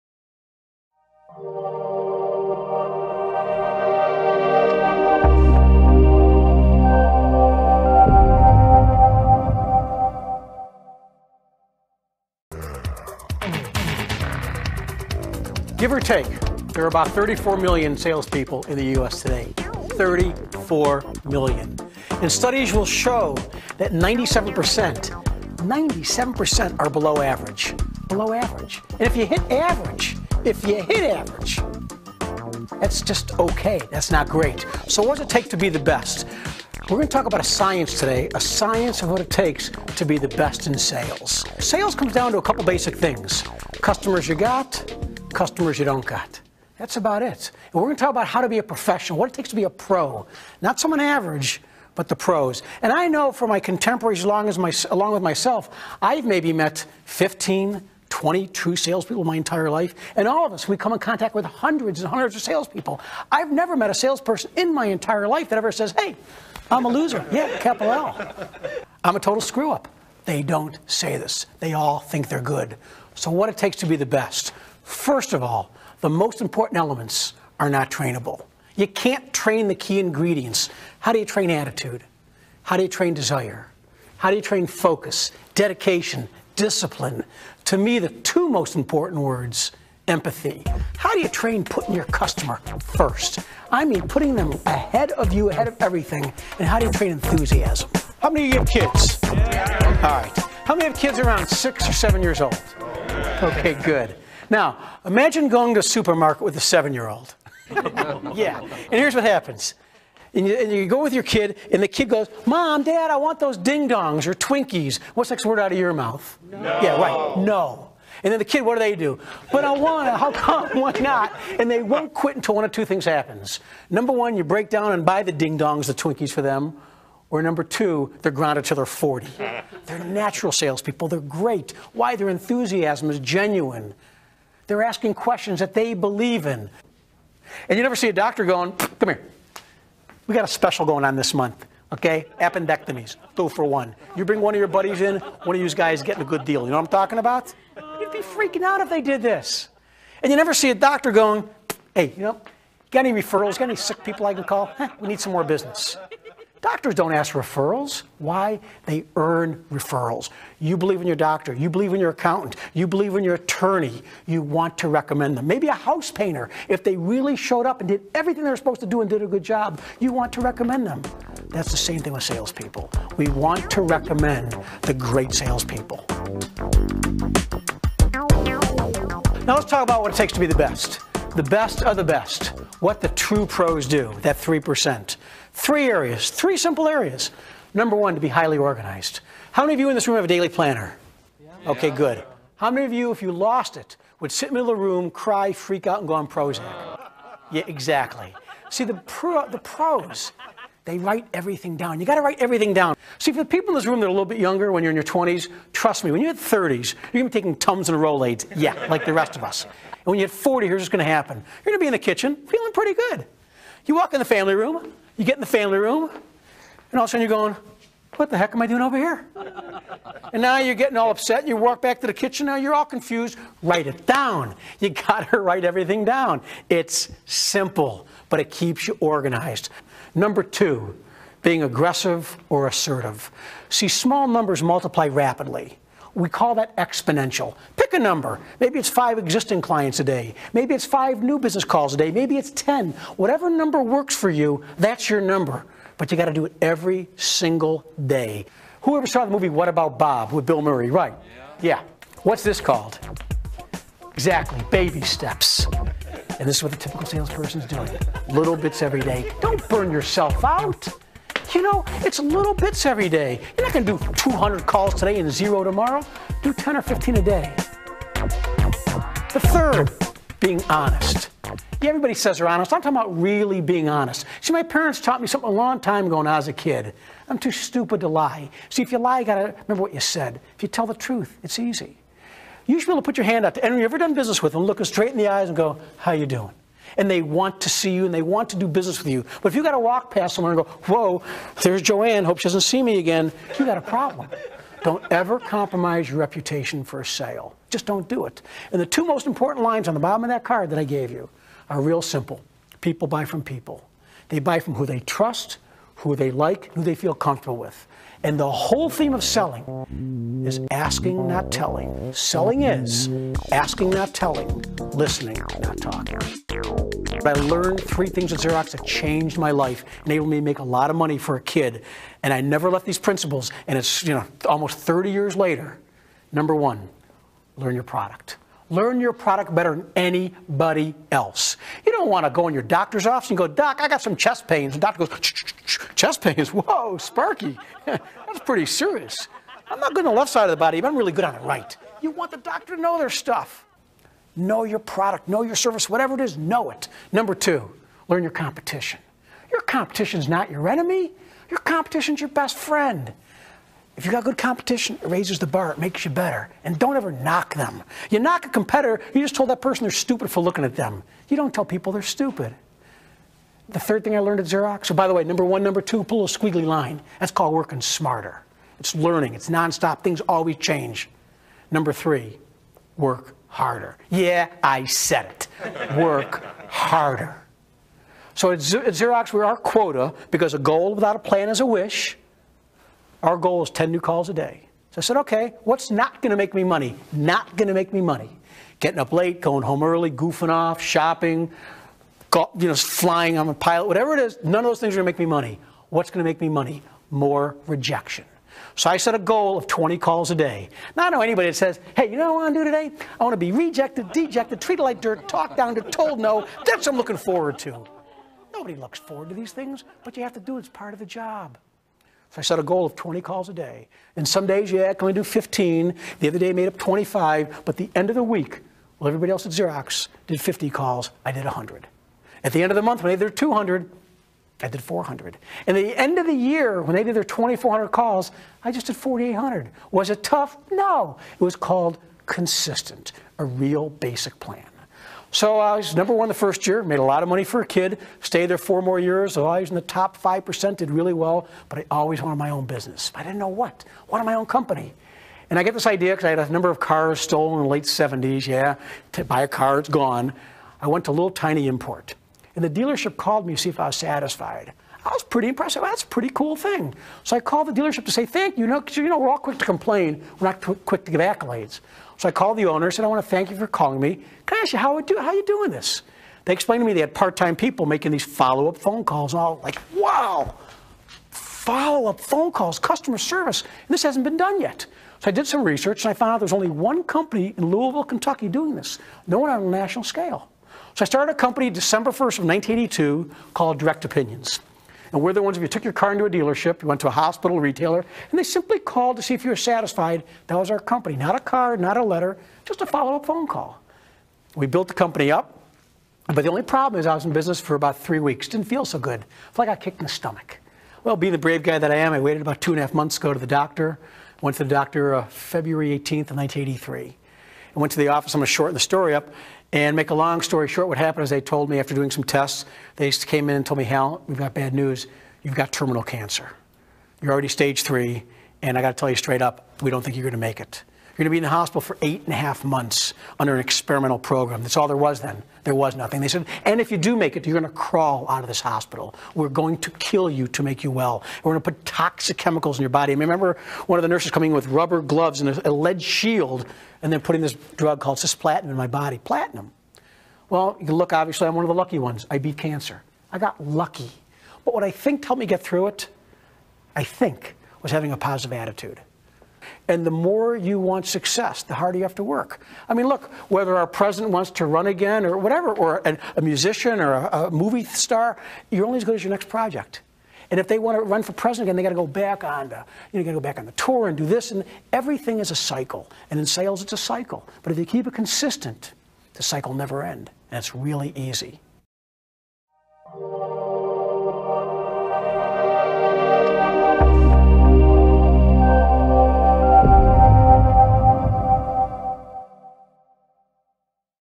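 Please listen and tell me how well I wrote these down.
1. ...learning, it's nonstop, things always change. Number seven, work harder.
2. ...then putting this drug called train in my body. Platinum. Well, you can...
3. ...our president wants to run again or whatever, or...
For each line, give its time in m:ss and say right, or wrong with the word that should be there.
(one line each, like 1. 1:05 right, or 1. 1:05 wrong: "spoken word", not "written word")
1. 6:08 wrong: "three", not "seven"
2. 8:57 wrong: "cisplatin", not "train"
3. 9:13 right.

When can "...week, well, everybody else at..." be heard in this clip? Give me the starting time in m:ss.
6:58.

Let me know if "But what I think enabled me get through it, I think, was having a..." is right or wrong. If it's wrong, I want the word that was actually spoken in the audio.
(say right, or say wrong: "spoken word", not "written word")
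wrong: "helped", not "enabled".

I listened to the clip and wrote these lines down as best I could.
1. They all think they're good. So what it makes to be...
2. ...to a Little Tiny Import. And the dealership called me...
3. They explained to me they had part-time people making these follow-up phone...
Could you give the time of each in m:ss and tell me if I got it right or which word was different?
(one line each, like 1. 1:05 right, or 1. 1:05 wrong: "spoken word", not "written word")
1. 1:11 wrong: "takes", not "makes"
2. 7:31 right
3. 7:46 right.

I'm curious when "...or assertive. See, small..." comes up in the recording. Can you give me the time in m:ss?
3:52.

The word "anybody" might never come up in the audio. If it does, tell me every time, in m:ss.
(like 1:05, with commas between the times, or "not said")
5:29, 6:41.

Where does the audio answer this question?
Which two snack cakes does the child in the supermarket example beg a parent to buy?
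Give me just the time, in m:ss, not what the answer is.
1:53.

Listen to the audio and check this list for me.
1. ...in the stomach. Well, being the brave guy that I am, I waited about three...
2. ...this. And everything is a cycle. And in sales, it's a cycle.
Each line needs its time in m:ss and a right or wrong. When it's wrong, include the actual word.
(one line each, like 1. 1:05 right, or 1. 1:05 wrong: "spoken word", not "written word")
1. 8:19 wrong: "two", not "three"
2. 9:24 right.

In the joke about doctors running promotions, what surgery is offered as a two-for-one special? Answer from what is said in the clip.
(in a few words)
Appendectomies.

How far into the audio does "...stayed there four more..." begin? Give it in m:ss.
7:18.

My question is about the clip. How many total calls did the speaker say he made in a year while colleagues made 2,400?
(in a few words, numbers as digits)
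4,800.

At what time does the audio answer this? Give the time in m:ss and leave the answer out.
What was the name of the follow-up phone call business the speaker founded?
8:03.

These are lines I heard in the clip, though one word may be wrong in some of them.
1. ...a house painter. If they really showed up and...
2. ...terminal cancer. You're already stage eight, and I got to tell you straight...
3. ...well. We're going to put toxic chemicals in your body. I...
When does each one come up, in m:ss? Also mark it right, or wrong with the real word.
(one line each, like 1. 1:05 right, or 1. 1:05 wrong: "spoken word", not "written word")
1. 2:45 right
2. 8:35 wrong: "three", not "eight"
3. 8:50 right.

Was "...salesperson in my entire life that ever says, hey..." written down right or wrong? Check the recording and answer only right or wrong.
right.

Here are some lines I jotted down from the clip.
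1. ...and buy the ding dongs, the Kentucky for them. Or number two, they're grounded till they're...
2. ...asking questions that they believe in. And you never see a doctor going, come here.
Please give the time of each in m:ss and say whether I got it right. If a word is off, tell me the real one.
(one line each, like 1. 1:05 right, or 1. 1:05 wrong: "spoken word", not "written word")
1. 2:04 wrong: "Twinkies", not "Kentucky"
2. 2:14 right.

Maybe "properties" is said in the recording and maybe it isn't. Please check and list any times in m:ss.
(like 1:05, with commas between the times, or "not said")
not said.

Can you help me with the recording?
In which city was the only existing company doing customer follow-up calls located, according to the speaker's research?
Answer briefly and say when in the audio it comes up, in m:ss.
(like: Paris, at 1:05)
Louisville, Kentucky, at 7:57.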